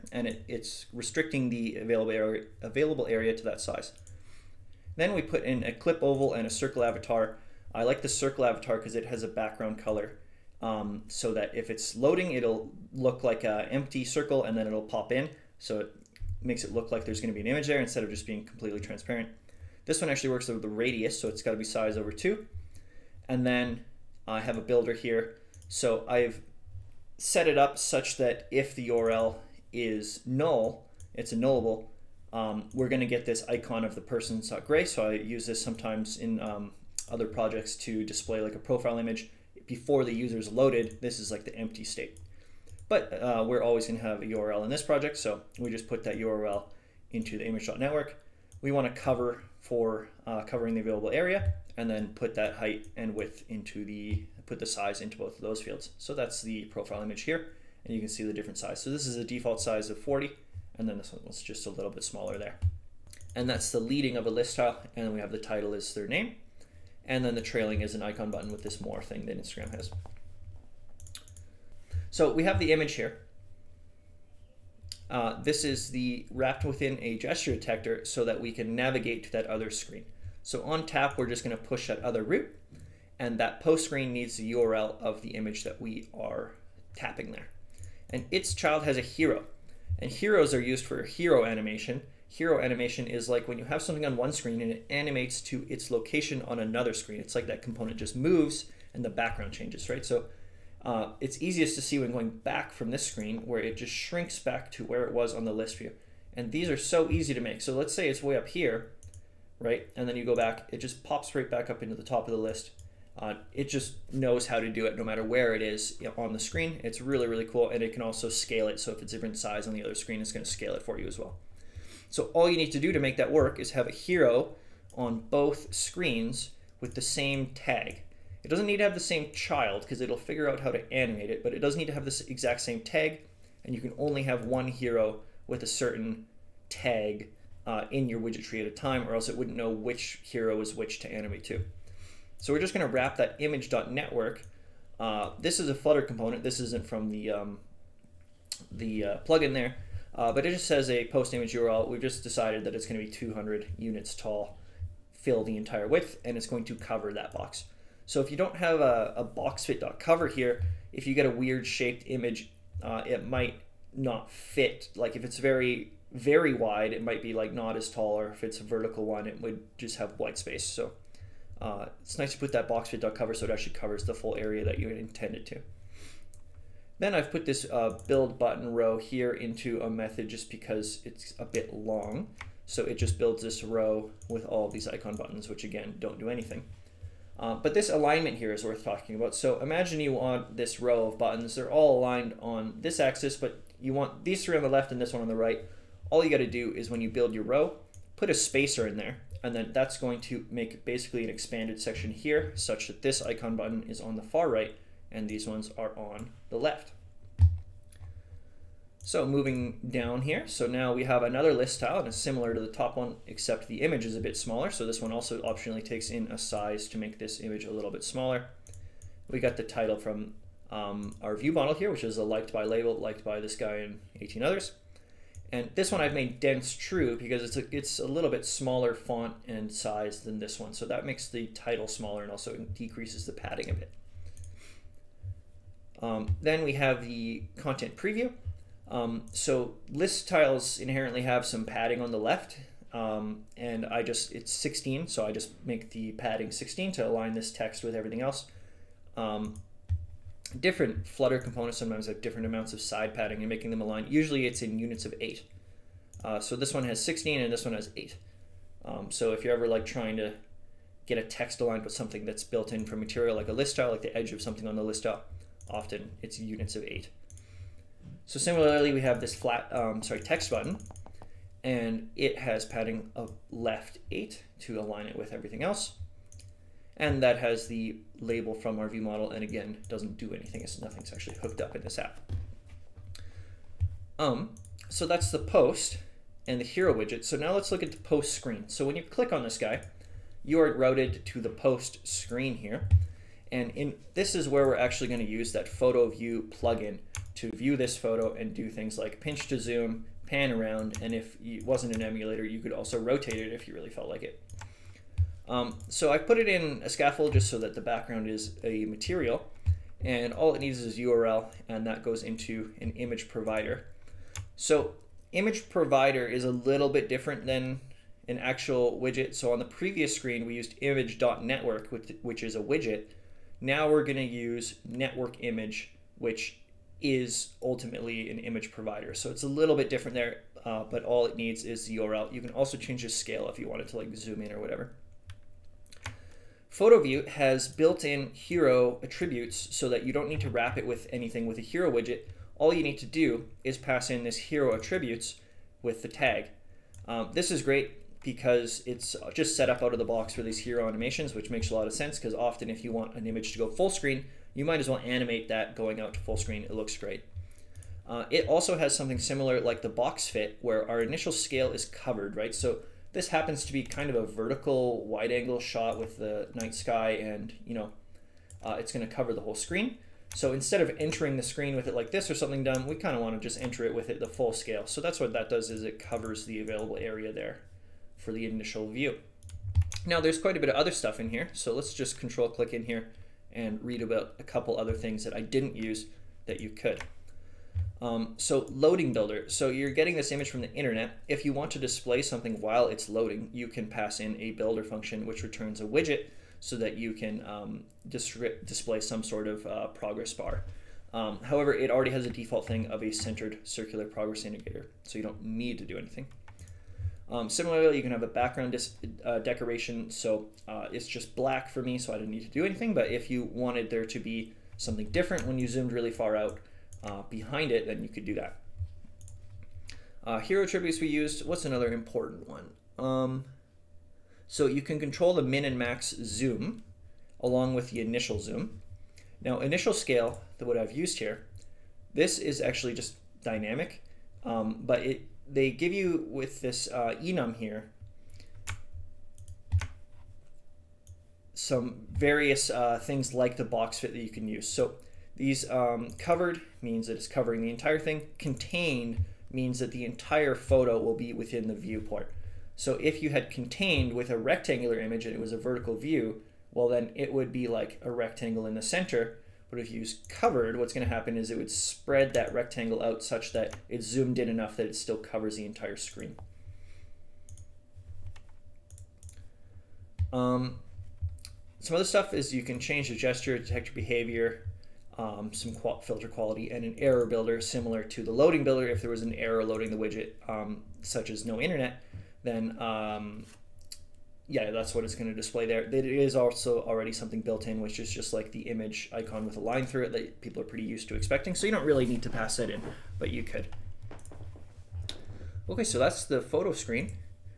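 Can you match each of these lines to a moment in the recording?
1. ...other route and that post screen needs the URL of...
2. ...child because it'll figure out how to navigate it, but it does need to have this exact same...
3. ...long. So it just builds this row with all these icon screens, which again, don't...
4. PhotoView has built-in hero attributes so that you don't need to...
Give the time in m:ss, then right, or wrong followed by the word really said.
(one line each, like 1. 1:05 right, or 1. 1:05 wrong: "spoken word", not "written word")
1. 1:22 right
2. 2:09 wrong: "animate", not "navigate"
3. 3:01 wrong: "buttons", not "screens"
4. 5:36 right.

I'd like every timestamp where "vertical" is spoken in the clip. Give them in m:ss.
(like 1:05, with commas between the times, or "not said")
2:48, 6:04, 7:35.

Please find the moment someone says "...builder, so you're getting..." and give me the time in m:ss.
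6:29.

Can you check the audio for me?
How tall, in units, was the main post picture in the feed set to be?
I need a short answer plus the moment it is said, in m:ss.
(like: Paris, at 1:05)
200, at 2:33.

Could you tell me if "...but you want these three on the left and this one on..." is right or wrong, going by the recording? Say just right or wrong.
right.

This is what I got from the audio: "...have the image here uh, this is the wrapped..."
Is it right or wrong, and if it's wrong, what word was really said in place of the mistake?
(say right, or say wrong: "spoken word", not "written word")
right.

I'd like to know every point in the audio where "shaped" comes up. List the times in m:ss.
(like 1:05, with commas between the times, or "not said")
2:41.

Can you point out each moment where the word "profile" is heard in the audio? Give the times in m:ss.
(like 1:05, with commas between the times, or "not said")
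0:38, 0:56.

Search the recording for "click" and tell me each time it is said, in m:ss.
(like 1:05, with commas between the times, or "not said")
4:49, 6:22.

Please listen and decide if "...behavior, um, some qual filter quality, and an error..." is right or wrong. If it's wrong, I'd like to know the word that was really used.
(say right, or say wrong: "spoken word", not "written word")
right.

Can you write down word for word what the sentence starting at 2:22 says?
So we're just going to wrap that image.network.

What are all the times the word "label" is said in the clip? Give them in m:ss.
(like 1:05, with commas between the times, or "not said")
3:42, 4:38.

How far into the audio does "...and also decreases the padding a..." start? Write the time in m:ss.
3:52.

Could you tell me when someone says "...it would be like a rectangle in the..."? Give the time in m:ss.
7:37.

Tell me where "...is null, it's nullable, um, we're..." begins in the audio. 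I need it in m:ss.
0:29.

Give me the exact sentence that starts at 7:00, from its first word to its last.
Uh, hero attributes we used, what's another important one?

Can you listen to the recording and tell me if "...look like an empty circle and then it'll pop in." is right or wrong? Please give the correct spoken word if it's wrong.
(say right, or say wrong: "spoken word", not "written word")
right.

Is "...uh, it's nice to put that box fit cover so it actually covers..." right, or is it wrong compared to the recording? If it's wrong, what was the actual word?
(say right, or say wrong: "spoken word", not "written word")
right.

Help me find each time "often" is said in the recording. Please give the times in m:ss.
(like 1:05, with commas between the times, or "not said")
4:25, 5:52.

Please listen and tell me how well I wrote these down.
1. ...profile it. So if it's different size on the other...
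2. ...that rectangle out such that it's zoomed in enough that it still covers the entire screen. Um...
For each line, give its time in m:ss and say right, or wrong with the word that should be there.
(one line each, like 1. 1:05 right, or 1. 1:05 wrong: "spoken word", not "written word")
1. 1:58 wrong: "scale", not "profile"
2. 7:42 right.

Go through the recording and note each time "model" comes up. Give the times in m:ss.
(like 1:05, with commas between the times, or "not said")
3:41, 4:39.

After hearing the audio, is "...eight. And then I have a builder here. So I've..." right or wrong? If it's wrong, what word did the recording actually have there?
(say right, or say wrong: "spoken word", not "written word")
wrong: "two", not "eight".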